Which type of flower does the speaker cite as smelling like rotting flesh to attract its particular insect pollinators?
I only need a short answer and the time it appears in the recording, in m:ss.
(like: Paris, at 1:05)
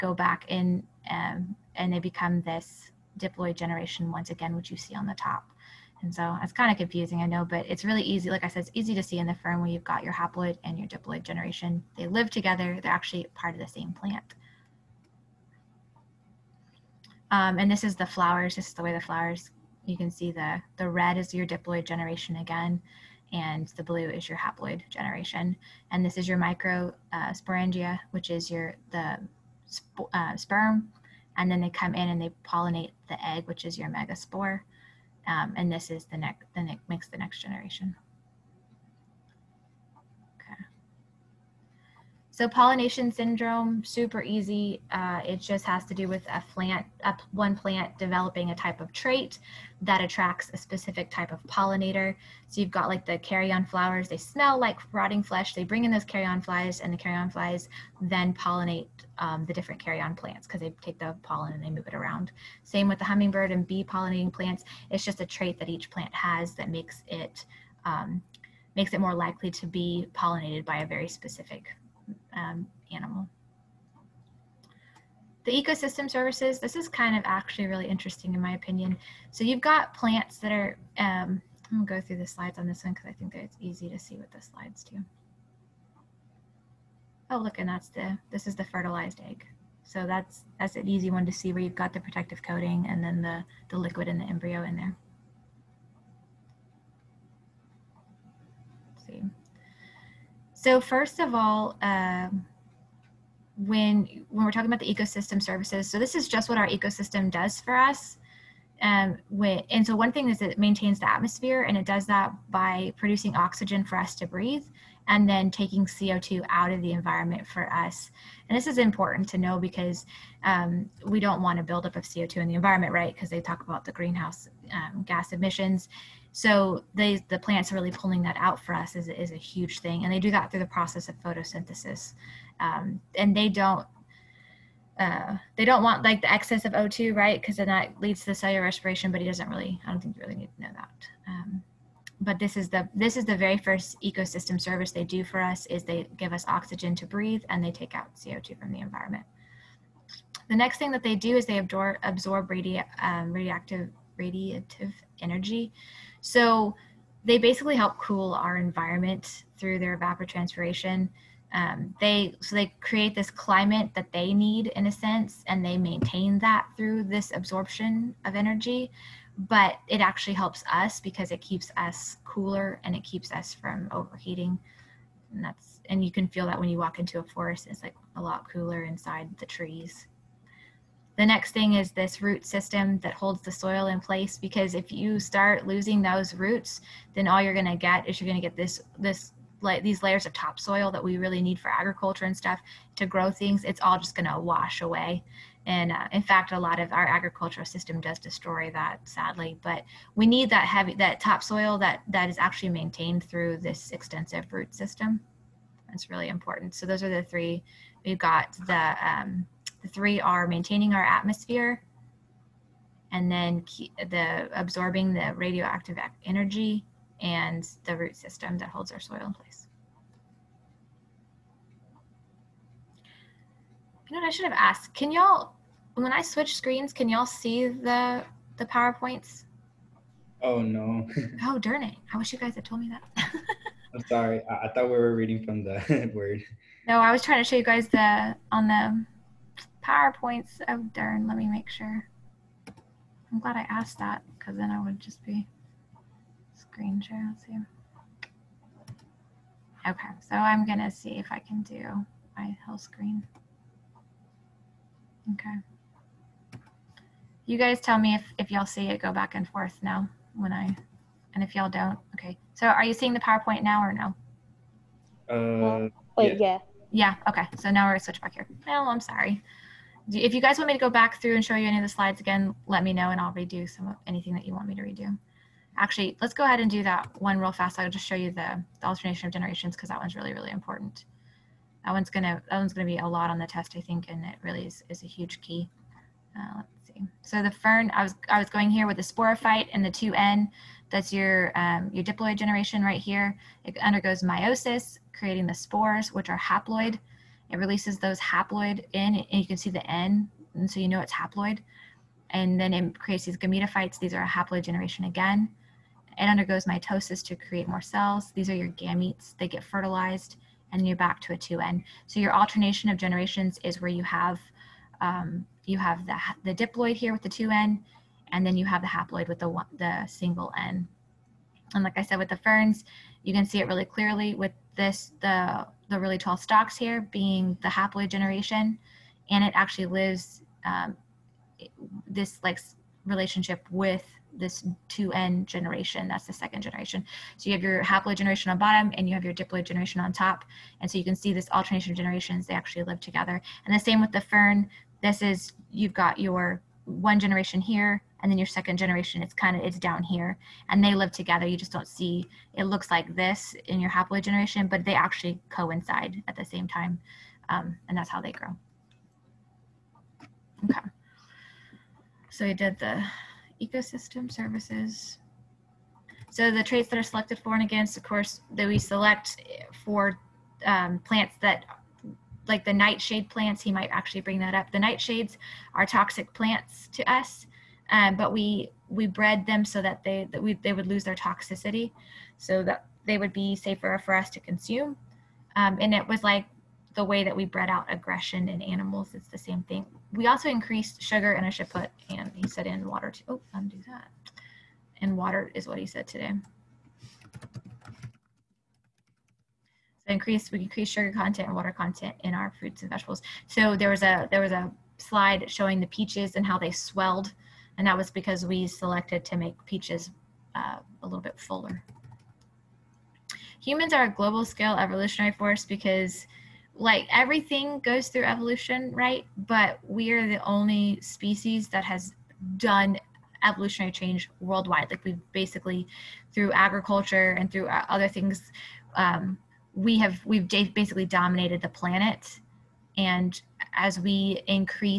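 Carrion flowers, at 0:53.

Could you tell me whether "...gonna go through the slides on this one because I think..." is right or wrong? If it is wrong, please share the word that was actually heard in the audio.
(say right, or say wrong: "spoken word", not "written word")
right.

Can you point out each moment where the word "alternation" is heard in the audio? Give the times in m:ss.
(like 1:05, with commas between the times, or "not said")
4:38, 5:12, 5:41.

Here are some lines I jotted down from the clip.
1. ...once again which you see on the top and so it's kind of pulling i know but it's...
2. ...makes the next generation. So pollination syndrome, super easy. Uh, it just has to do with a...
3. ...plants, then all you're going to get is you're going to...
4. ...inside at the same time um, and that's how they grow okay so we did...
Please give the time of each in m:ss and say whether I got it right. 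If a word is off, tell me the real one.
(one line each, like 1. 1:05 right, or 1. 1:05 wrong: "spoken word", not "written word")
1. 0:04 wrong: "confusing", not "pulling"
2. 0:36 right
3. 3:06 wrong: "roots", not "plants"
4. 5:55 wrong: "coincide", not "inside".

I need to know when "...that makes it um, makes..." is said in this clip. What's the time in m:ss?
1:06.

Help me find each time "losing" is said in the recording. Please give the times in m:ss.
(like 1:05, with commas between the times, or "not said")
3:05.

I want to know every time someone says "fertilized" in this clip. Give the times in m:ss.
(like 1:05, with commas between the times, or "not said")
1:28, 5:09.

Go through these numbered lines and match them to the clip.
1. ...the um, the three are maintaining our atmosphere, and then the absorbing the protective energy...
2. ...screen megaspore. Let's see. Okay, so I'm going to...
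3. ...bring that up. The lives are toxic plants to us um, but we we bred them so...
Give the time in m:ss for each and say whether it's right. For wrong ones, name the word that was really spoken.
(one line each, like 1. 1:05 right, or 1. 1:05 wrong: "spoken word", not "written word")
1. 3:28 wrong: "radioactive", not "protective"
2. 4:06 wrong: "share", not "megaspore"
3. 6:14 wrong: "nightshades", not "lives".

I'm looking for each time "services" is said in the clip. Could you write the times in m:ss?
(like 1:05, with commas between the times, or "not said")
1:16, 1:45, 2:24, 6:04.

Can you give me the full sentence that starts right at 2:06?
So they, the plants are really pulling that out for us is, is a huge thing.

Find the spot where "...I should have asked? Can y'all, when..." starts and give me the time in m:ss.
3:44.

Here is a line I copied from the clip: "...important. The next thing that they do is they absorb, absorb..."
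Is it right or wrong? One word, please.
wrong.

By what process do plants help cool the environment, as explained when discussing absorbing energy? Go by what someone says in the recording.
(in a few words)
Evapotranspiration.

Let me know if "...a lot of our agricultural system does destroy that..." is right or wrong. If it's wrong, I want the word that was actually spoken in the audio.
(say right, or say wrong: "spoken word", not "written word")
right.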